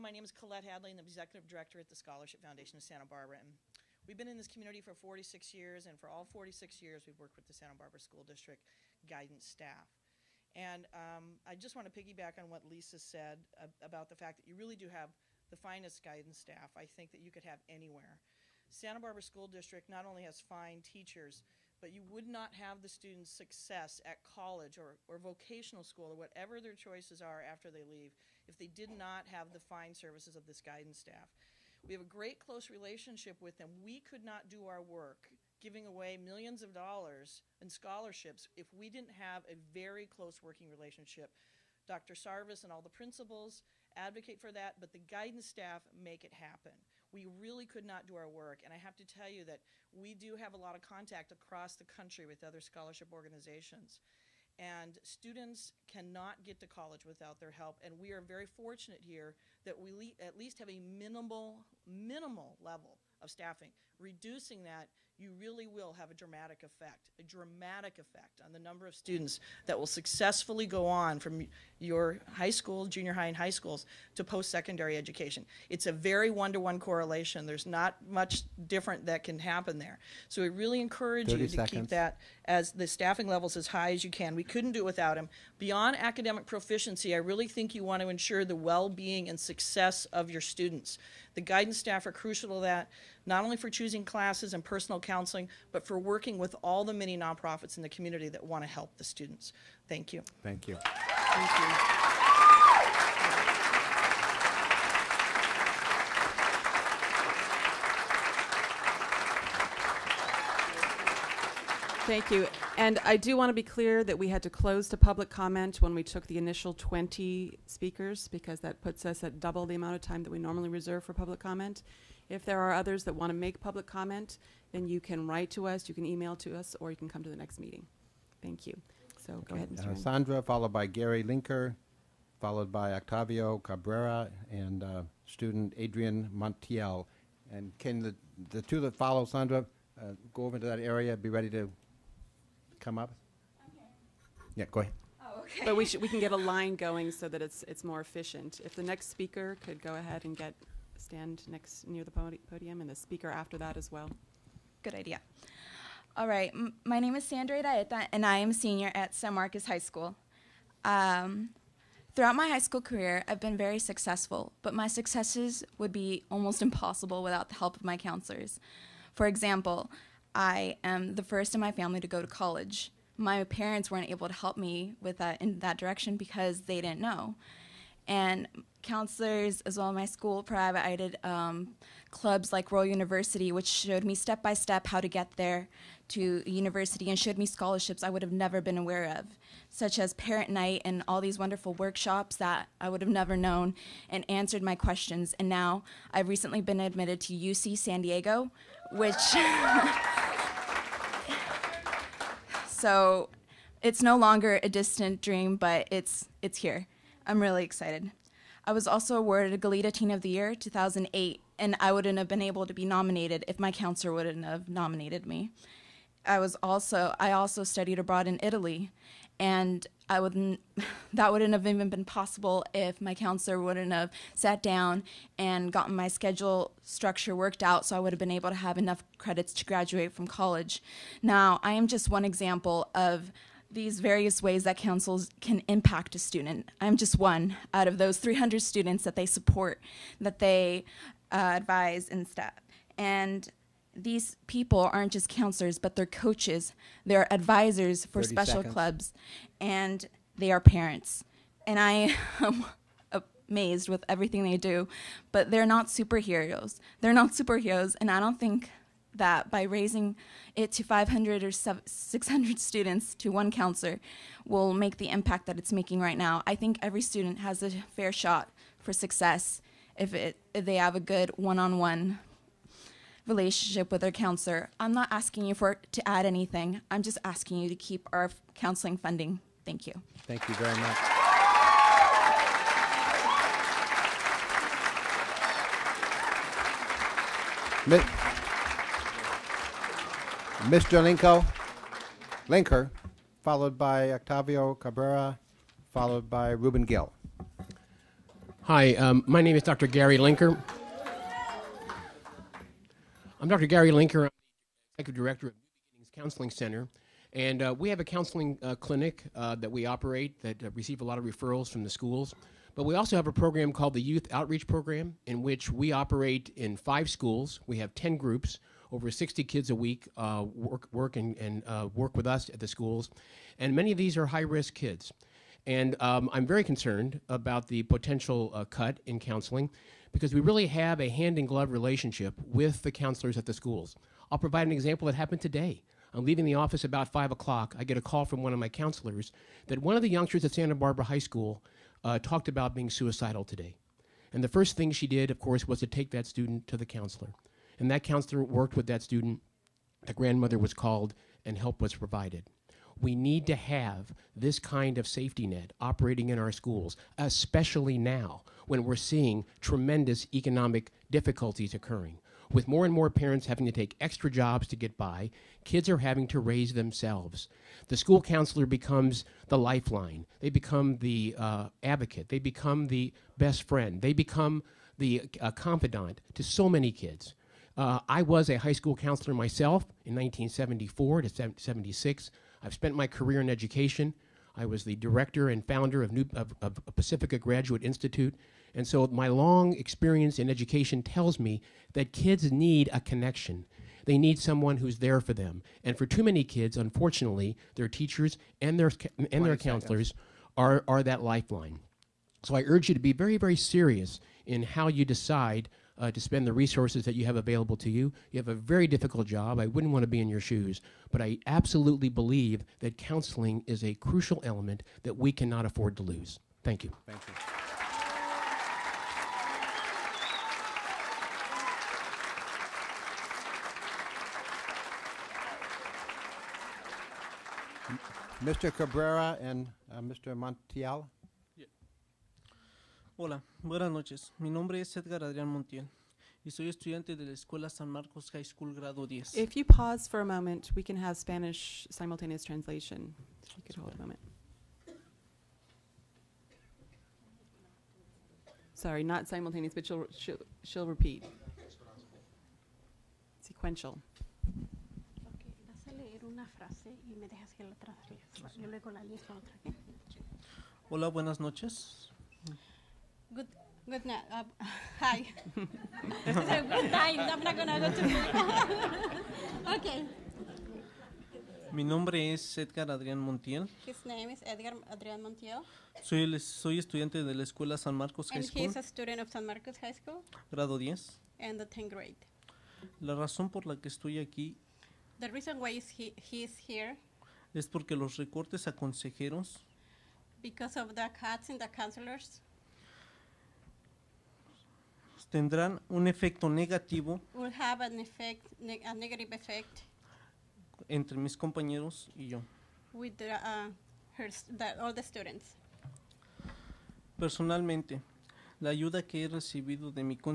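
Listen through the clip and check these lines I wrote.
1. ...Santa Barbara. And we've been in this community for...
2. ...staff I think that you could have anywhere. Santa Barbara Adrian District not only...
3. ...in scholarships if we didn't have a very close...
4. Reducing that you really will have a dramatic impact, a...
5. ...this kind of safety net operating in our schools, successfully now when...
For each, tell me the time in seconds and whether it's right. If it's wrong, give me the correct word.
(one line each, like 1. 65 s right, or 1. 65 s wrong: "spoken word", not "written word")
1. 2 s right
2. 16 s wrong: "School", not "Adrian"
3. 37 s right
4. 63 s wrong: "effect", not "impact"
5. 354 s wrong: "especially", not "successfully".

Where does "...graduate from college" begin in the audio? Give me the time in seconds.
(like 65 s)
229 s.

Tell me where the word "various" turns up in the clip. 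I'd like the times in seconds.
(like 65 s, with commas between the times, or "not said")
234 s.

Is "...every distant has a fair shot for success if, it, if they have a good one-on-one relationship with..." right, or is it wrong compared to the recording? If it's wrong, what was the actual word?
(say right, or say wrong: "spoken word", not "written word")
wrong: "student", not "distant".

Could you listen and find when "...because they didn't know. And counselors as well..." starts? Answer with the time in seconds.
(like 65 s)
176 s.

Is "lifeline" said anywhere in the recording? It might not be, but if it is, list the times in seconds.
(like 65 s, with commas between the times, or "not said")
369 s, 401 s.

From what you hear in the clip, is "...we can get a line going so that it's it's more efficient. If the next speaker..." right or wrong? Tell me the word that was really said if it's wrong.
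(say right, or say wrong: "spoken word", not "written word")
right.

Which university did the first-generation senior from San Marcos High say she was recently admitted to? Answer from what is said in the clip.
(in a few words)
UC San Diego.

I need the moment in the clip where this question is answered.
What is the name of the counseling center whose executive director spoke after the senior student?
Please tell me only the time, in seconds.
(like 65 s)
305 s.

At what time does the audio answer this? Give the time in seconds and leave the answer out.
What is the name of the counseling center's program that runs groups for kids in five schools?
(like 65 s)
314 s.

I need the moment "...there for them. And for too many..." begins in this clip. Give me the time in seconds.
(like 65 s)
394 s.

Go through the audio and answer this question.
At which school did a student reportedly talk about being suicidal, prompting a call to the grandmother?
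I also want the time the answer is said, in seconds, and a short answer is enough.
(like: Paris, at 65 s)
Santa Barbara High School, at 340 s.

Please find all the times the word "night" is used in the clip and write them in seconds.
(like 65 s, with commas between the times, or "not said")
190 s, 464 s.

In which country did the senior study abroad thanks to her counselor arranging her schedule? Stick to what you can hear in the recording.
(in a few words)
Italy.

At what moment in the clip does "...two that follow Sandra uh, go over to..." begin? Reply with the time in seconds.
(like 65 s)
138 s.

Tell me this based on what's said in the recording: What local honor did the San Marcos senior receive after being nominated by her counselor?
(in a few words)
Goleta Teen of the Year.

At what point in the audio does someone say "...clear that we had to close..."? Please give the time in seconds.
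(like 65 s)
113 s.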